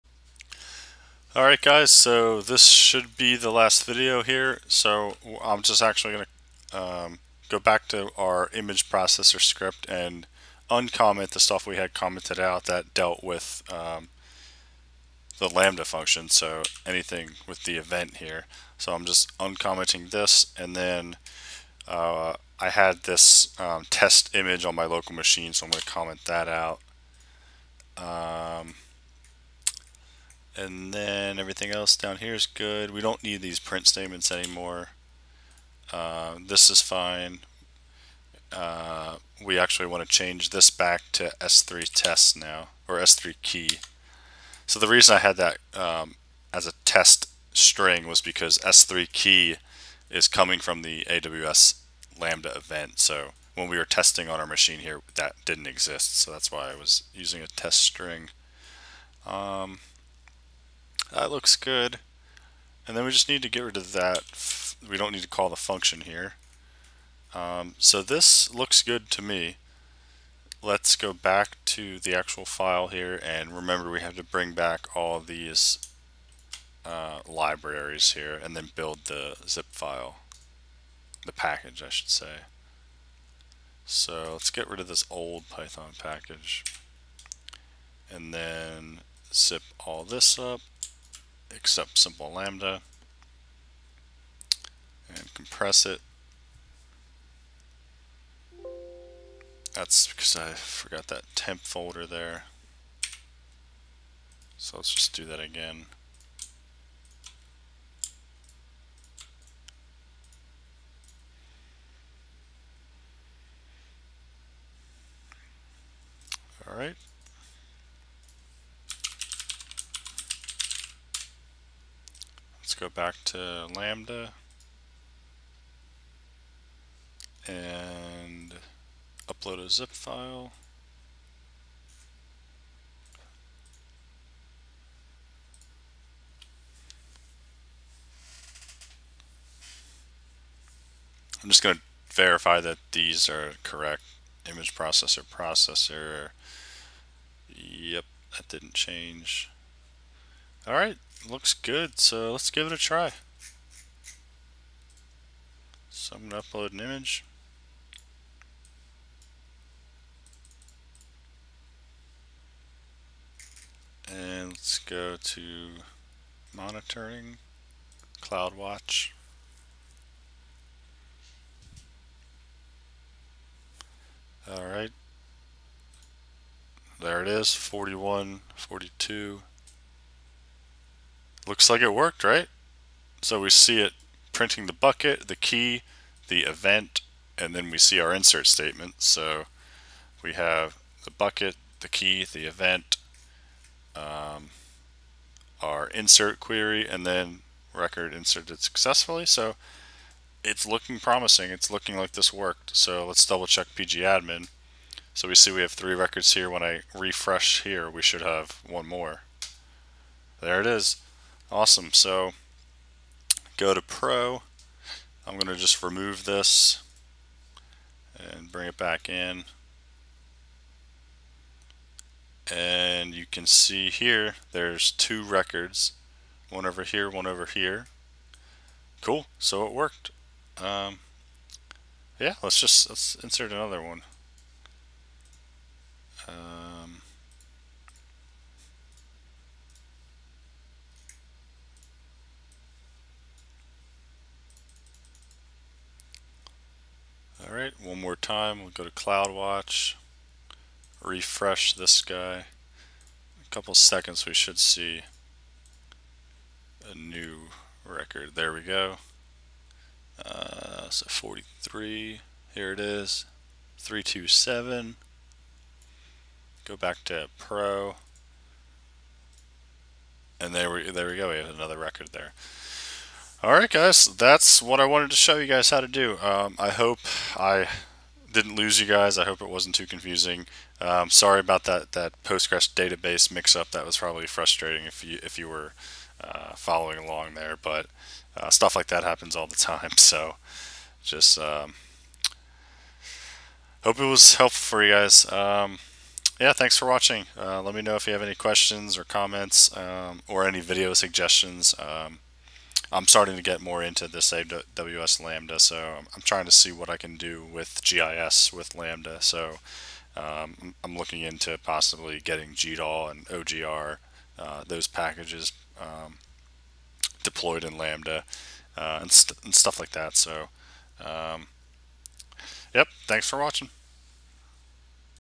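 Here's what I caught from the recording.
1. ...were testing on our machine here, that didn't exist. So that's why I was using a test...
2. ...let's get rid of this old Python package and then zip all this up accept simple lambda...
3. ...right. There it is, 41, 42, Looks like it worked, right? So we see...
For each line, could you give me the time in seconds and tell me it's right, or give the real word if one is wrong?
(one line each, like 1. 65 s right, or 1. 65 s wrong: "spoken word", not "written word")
1. 53 s right
2. 84 s right
3. 174 s right.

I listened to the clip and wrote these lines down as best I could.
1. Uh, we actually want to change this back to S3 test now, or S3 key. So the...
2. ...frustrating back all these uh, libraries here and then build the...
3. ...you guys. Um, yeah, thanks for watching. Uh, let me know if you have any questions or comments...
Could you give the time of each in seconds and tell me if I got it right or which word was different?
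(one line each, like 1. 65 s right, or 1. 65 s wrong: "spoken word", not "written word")
1. 38 s right
2. 74 s wrong: "bring", not "frustrating"
3. 294 s right.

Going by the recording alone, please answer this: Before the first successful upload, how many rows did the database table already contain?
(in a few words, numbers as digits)
3.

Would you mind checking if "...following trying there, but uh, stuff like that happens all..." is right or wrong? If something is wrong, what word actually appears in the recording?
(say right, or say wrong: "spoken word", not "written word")
wrong: "along", not "trying".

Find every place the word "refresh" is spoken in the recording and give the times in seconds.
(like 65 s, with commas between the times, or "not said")
206 s, 251 s.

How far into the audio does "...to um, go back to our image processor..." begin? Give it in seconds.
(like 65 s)
6 s.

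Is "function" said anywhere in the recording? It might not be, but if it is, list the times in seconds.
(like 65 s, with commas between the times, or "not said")
15 s, 65 s.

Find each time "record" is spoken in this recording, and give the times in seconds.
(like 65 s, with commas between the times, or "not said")
197 s, 205 s, 225 s, 257 s, 271 s.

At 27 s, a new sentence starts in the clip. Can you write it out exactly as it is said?
Um, and then everything else down here is good.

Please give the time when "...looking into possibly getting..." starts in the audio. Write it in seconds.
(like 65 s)
310 s.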